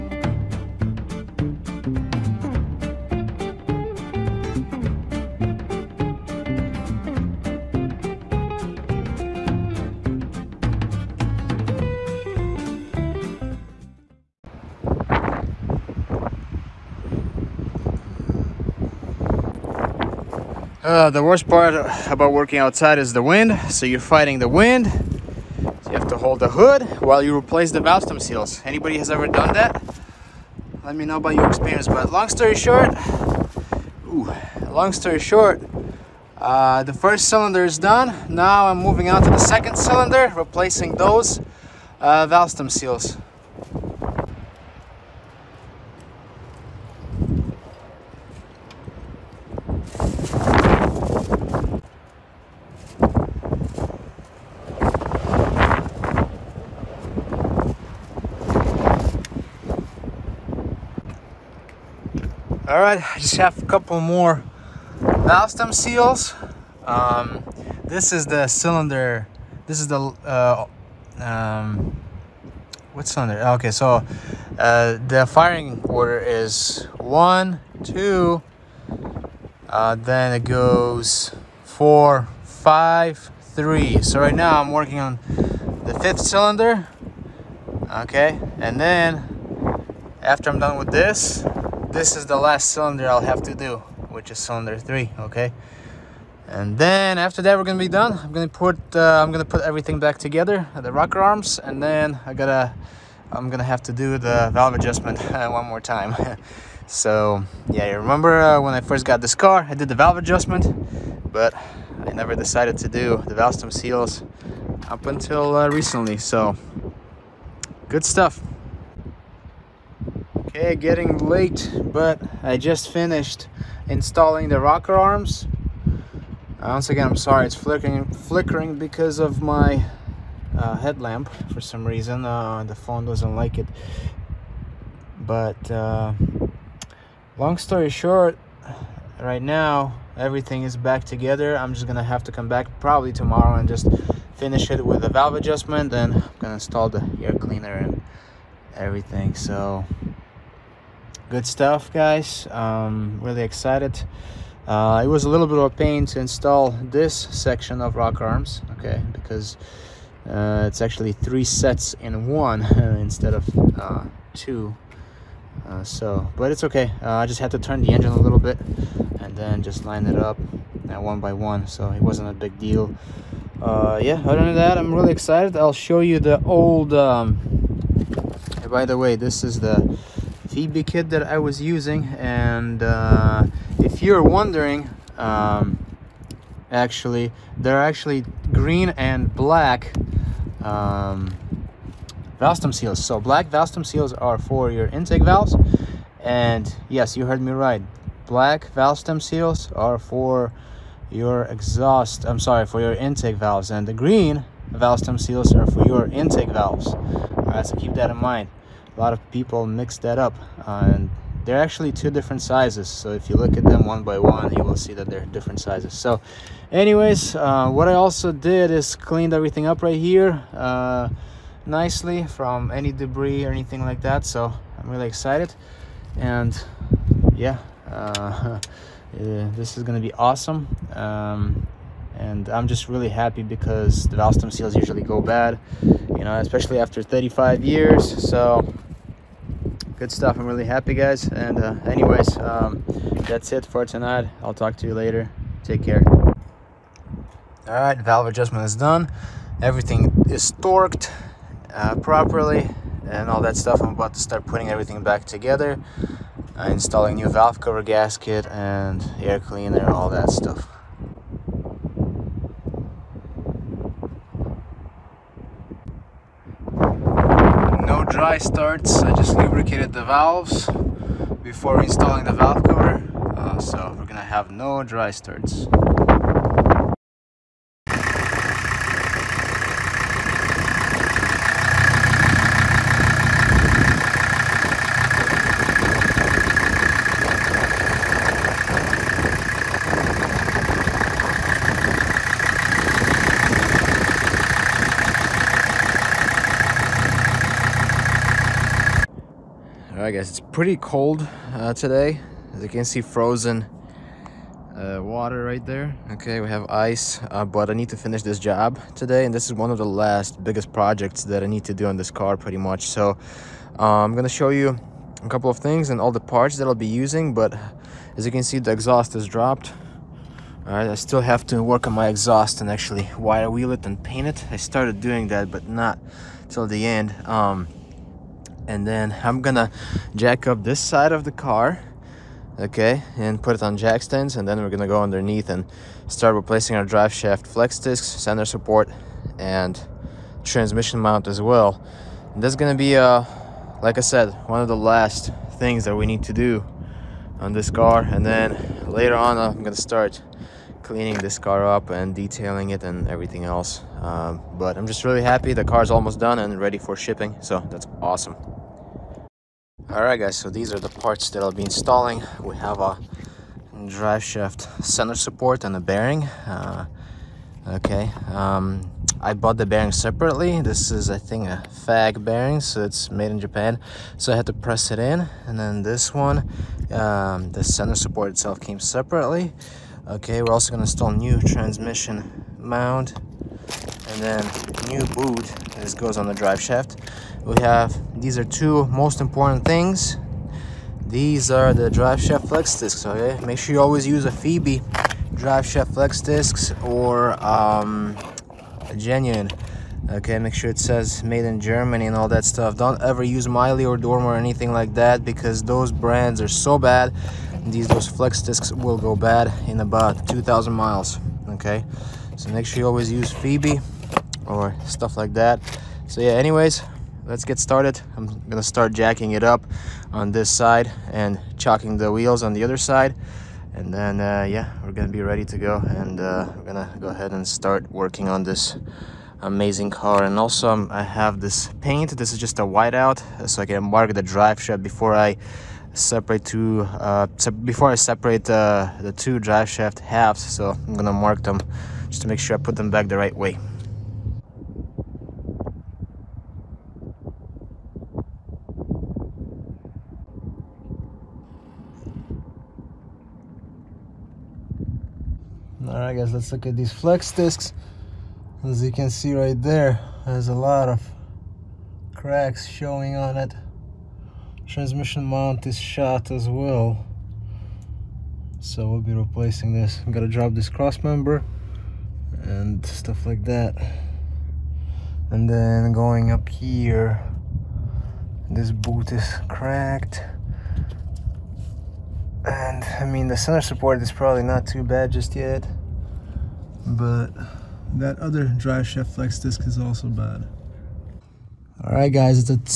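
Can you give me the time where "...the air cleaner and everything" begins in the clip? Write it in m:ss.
2:26.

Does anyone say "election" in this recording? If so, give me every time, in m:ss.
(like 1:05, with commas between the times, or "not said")
not said.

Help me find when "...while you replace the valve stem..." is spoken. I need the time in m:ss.
0:27.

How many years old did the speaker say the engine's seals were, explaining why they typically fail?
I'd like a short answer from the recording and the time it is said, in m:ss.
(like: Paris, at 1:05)
35 years, at 3:57.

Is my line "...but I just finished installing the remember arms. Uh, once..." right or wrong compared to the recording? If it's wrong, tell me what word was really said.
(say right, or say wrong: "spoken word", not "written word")
wrong: "rocker", not "remember".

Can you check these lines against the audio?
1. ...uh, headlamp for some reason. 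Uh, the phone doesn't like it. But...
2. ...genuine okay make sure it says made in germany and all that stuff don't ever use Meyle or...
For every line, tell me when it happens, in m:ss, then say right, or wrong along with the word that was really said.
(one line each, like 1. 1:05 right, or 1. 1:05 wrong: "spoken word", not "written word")
1. 2:10 right
2. 6:38 right.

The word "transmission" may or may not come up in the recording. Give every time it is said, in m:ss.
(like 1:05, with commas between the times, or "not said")
5:40, 6:21, 7:44.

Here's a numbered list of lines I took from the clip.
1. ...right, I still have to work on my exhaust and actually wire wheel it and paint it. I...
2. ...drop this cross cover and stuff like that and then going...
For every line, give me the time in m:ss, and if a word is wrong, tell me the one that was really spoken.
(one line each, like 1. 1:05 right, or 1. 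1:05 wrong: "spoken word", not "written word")
1. 5:20 right
2. 7:50 wrong: "member", not "cover".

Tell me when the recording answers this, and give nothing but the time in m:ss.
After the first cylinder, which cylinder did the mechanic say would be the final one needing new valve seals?
1:34.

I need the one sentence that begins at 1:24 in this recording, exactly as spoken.
So right now I'm working on the fifth cylinder.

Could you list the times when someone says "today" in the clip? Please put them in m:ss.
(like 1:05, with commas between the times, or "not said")
5:01, 5:08.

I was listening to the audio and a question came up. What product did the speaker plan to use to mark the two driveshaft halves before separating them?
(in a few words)
whiteout.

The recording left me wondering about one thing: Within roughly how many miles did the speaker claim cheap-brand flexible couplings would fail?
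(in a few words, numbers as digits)
2000 miles.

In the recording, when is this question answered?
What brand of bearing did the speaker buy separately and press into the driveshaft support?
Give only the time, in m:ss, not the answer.
6:11.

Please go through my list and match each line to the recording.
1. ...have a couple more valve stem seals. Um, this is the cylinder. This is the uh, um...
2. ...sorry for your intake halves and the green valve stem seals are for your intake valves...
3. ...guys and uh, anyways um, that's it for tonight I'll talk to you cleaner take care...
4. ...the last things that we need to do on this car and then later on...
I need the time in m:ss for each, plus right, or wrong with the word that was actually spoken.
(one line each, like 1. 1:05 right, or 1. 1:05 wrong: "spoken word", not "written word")
1. 1:03 right
2. 3:22 wrong: "valves", not "halves"
3. 4:00 wrong: "later", not "cleaner"
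4. 5:44 right.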